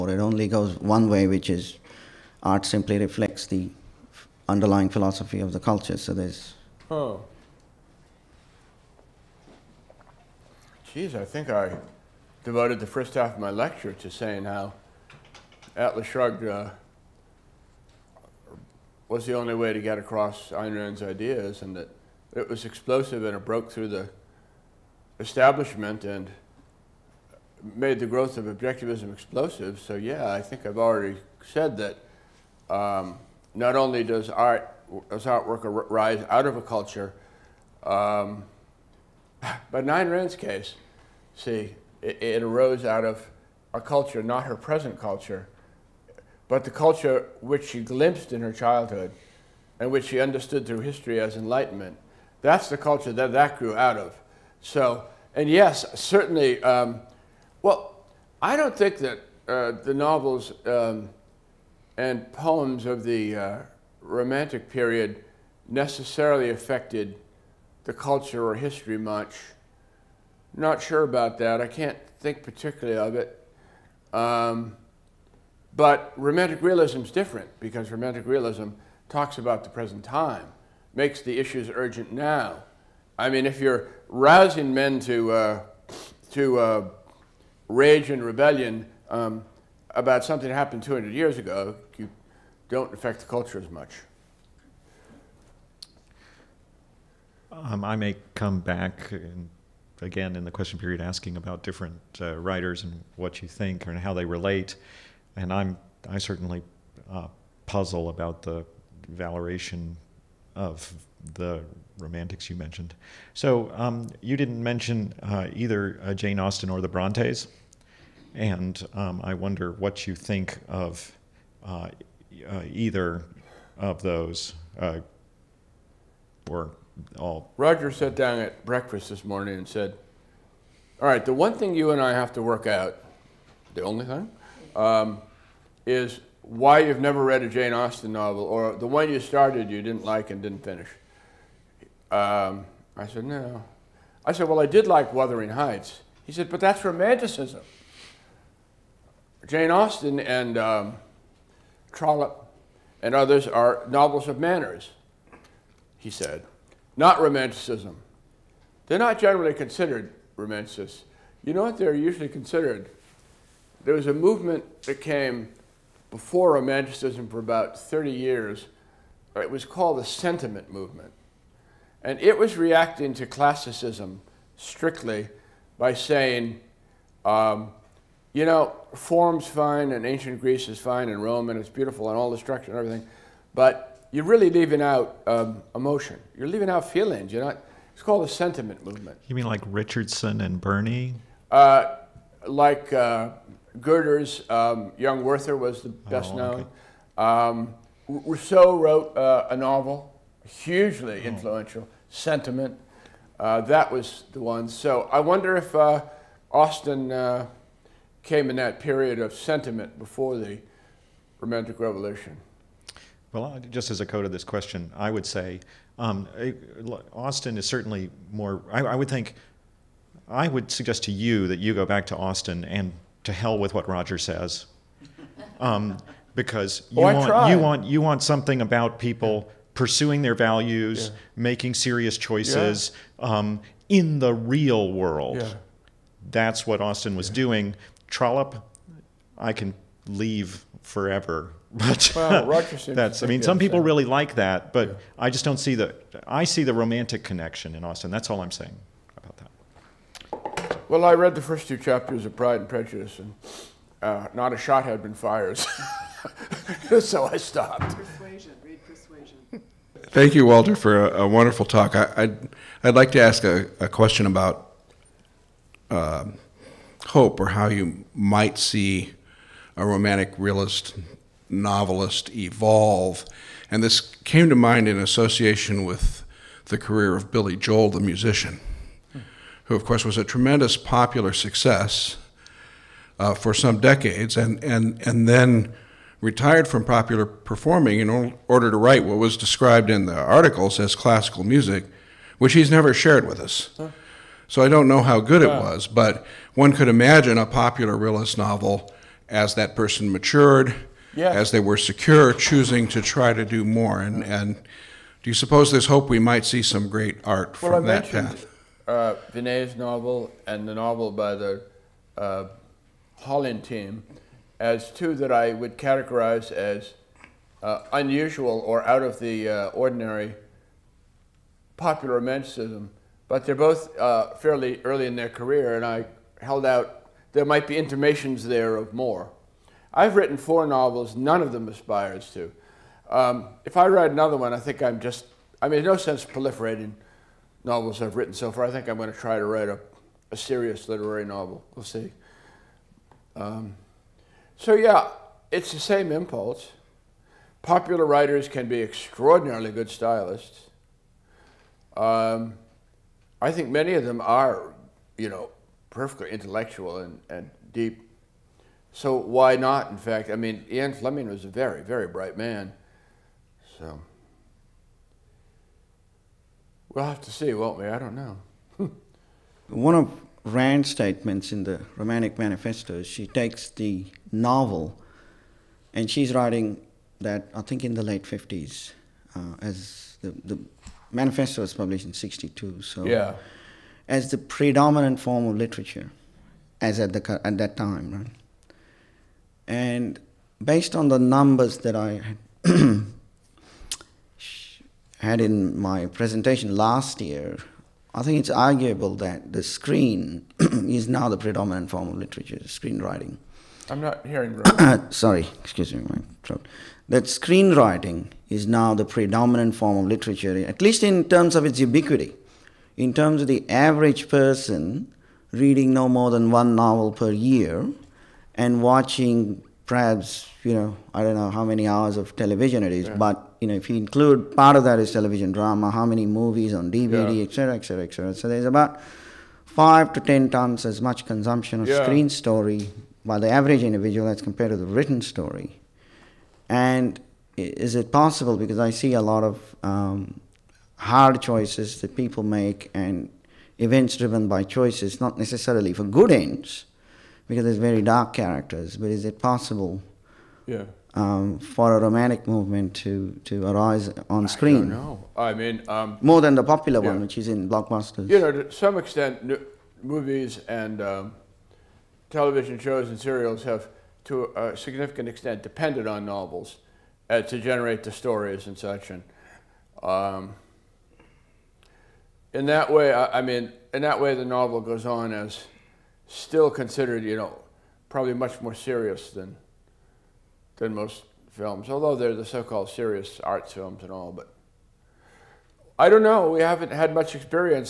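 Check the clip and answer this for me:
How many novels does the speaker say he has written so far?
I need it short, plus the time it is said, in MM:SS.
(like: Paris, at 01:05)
4, at 05:30.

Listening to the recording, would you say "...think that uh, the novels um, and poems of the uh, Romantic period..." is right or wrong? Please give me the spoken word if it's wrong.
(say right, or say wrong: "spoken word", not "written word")
right.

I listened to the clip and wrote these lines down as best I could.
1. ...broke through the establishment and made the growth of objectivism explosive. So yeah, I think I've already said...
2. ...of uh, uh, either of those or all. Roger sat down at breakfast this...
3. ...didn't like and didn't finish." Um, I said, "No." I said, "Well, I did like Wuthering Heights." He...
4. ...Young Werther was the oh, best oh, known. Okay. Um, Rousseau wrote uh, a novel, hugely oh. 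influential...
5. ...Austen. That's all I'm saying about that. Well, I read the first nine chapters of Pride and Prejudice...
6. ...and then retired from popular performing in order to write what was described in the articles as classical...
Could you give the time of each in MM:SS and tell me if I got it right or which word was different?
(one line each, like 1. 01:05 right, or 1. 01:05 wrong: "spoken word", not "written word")
1. 00:23 right
2. 02:00 right
3. 02:19 right
4. 03:14 right
5. 04:07 wrong: "two", not "nine"
6. 04:45 right.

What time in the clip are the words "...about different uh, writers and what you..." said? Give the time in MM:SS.
01:41.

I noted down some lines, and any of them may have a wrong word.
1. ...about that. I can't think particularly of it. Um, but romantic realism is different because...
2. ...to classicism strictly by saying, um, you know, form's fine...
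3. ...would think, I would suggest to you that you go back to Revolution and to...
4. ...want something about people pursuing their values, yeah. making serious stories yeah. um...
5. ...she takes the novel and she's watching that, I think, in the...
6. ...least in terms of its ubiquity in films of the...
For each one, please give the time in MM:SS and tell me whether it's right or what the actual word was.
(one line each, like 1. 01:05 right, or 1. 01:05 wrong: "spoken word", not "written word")
1. 01:11 right
2. 02:53 right
3. 03:38 wrong: "Austen", not "Revolution"
4. 03:48 wrong: "choices", not "stories"
5. 06:13 wrong: "writing", not "watching"
6. 06:50 wrong: "terms", not "films".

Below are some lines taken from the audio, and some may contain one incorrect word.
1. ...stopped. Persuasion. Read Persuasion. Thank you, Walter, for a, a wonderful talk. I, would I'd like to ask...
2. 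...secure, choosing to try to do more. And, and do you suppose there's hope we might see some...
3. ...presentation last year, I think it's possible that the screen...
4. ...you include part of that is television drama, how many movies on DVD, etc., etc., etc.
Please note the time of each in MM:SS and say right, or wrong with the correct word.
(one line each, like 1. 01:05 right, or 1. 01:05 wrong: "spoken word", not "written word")
1. 04:17 right
2. 05:01 right
3. 06:36 wrong: "arguable", not "possible"
4. 07:03 right.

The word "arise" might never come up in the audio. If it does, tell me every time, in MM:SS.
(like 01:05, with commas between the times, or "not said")
00:35, 07:33.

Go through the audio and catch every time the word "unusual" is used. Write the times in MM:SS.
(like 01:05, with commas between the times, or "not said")
05:17.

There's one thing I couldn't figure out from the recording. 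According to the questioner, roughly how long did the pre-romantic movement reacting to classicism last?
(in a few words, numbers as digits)
30 years.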